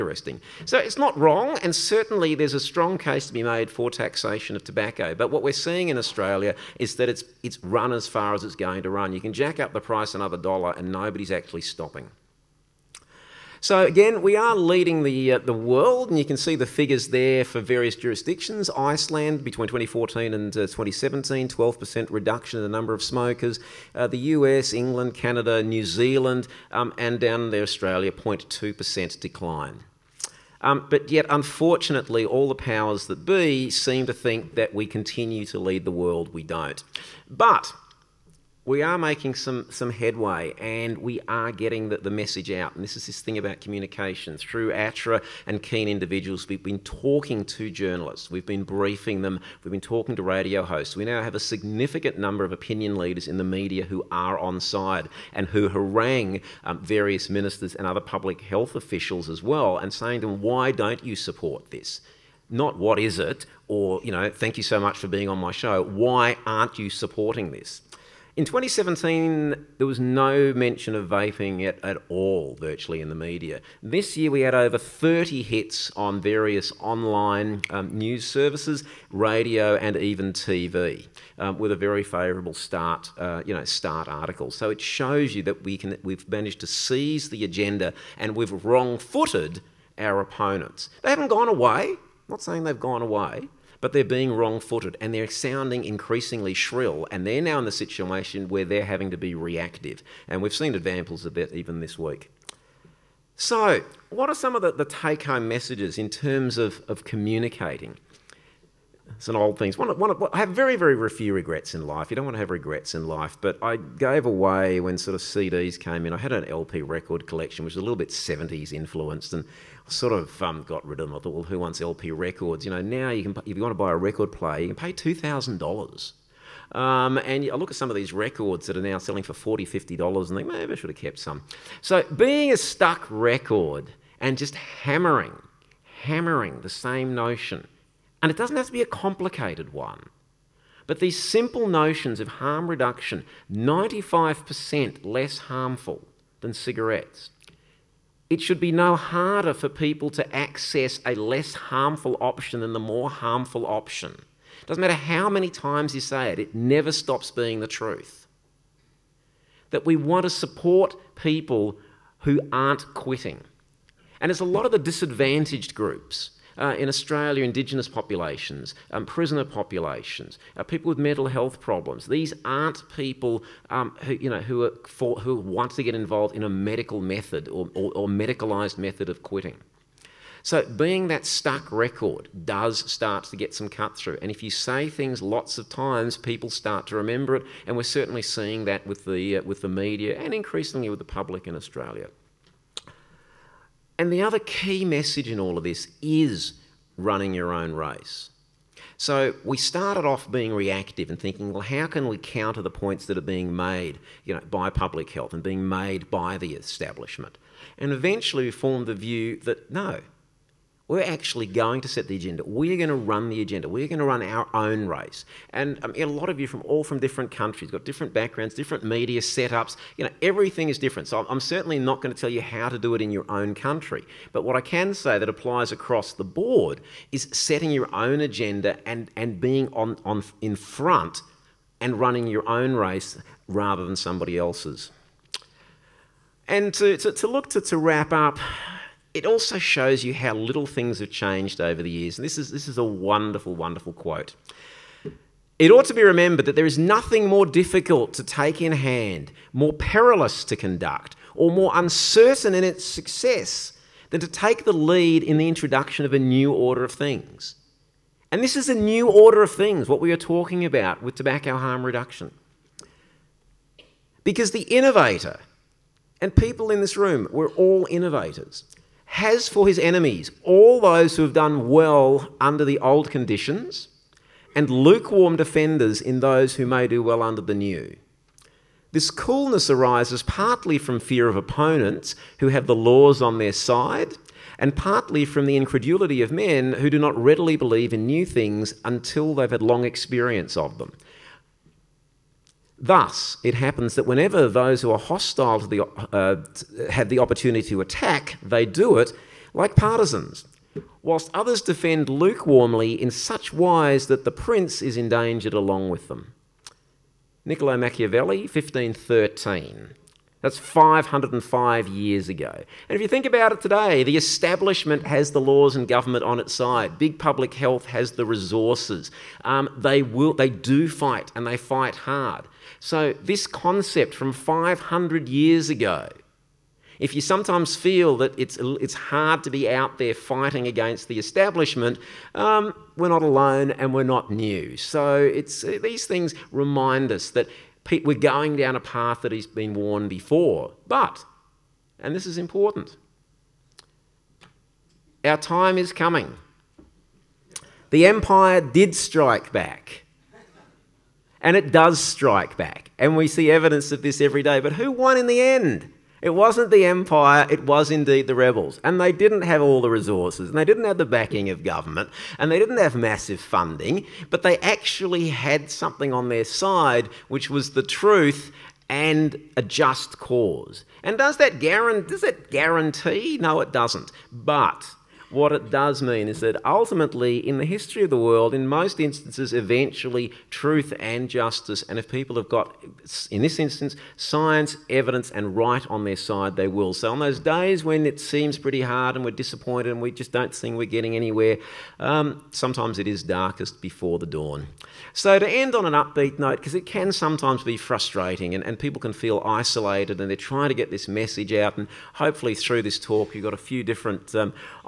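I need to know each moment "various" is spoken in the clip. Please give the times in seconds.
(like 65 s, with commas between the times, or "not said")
17 s, 56 s, 76 s.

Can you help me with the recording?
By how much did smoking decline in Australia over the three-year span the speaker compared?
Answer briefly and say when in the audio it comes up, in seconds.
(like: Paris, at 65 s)
0.2%, at 28 s.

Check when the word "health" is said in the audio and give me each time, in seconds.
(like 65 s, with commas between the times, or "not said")
58 s, 171 s, 205 s, 317 s.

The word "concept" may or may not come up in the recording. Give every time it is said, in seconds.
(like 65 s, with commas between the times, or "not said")
323 s.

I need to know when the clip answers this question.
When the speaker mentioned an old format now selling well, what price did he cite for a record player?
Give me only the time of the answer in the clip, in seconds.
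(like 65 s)
124 s.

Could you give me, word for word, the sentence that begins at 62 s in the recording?
Not what is it, or, you know, thank you so much for being on my show.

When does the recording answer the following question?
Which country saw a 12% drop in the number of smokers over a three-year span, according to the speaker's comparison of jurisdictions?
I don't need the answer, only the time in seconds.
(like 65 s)
18 s.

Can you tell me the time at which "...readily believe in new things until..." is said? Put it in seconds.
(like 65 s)
287 s.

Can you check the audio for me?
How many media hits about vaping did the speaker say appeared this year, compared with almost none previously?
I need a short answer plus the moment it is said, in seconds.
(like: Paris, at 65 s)
over 30, at 74 s.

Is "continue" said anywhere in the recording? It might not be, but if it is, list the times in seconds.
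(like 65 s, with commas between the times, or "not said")
34 s.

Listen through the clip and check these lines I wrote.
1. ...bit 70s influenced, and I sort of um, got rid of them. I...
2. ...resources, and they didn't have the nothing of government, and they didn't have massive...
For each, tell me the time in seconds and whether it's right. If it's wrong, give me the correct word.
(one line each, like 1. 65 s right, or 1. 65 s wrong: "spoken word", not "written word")
1. 117 s right
2. 359 s wrong: "backing", not "nothing".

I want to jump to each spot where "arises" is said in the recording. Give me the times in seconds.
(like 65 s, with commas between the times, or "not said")
279 s.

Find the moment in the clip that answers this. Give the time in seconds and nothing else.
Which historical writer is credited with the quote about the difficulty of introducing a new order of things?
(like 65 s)
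307 s.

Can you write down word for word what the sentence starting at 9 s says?
You can jack up the price another dollar and nobody's actually stopping.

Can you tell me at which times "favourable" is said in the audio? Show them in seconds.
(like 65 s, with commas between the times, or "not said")
82 s.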